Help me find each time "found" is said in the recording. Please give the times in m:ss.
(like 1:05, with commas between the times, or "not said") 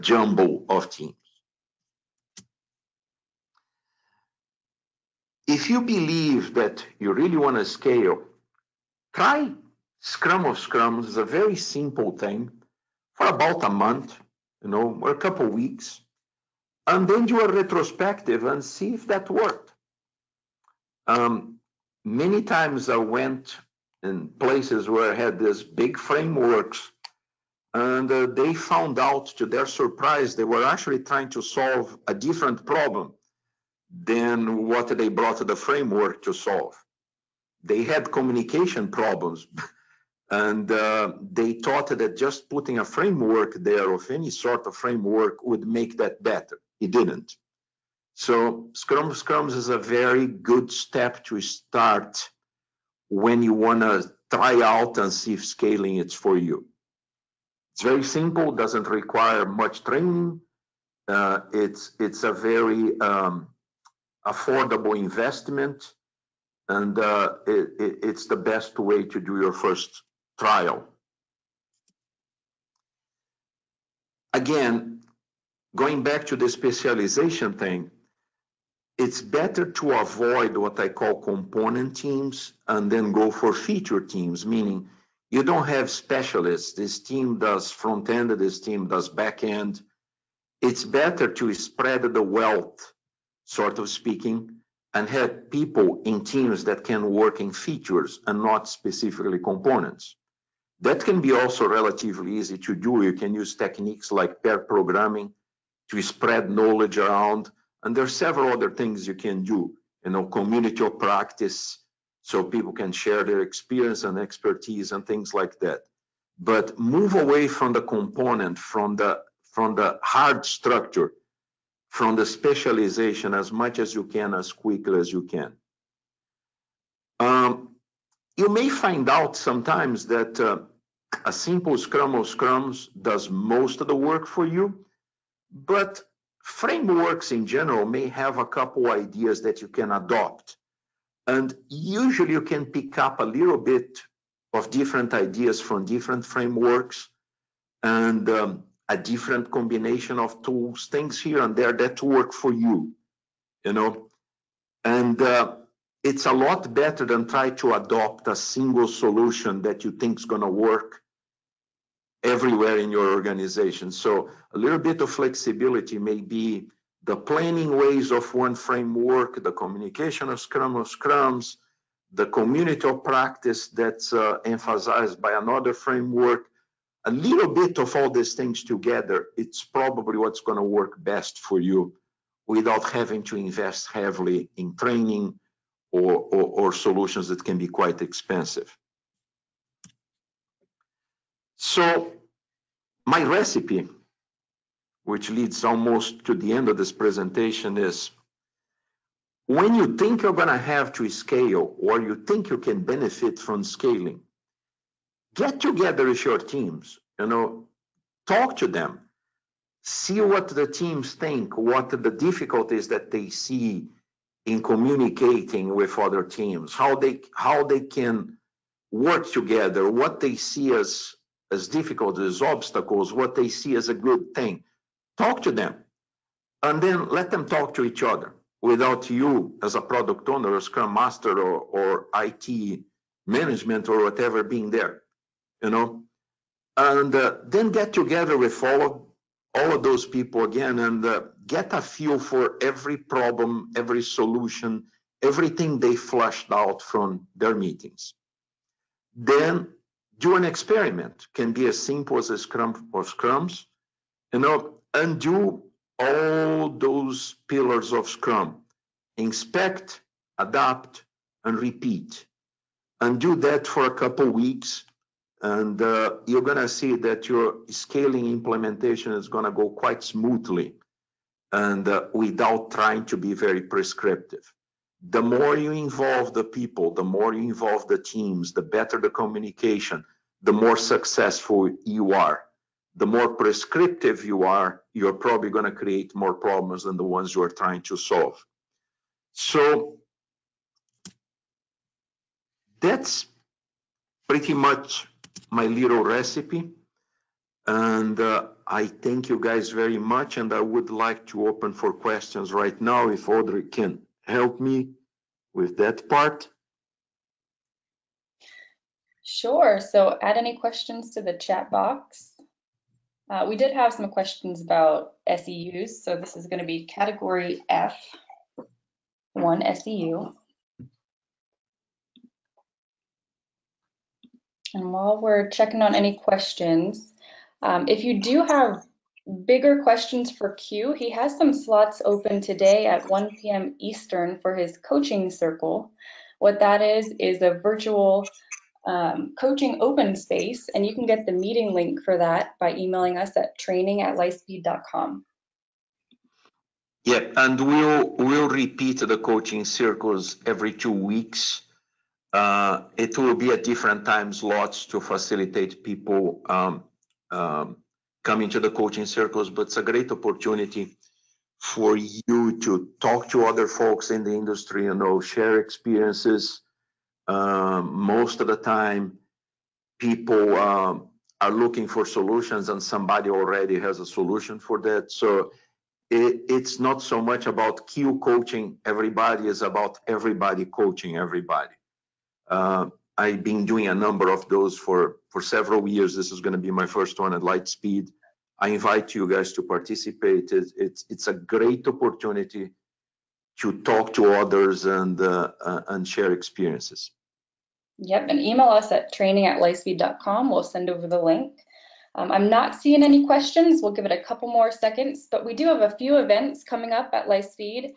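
0:28.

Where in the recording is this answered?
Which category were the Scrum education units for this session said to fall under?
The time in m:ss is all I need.
5:16.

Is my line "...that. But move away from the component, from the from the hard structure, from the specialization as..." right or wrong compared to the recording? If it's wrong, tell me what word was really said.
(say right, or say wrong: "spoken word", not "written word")
right.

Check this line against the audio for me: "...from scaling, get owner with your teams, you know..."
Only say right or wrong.
wrong.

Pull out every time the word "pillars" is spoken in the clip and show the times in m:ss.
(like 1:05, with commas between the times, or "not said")
4:17.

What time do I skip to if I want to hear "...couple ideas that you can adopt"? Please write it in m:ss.
2:18.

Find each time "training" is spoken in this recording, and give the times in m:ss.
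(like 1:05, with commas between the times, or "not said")
0:59, 3:04, 5:43, 6:39.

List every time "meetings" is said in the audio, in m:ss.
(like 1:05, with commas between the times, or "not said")
4:07, 5:41.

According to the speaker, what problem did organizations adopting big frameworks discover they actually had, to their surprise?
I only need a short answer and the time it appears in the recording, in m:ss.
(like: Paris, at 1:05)
Communication problems, at 0:38.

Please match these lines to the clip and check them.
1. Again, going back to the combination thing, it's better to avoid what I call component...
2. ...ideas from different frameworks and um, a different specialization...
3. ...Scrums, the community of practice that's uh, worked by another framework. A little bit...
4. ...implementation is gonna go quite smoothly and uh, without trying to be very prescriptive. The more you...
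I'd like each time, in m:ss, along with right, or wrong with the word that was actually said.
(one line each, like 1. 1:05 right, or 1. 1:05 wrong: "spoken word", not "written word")
1. 1:14 wrong: "specialization", not "combination"
2. 2:25 wrong: "combination", not "specialization"
3. 2:50 wrong: "emphasized", not "worked"
4. 4:28 right.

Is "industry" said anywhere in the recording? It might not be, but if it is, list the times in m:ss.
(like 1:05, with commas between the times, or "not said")
6:04.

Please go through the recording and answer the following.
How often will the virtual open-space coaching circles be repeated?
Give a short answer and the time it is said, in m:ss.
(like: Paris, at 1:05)
Every two weeks, at 5:50.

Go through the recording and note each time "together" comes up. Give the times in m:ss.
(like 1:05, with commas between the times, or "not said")
2:58, 3:25, 3:39, 3:57.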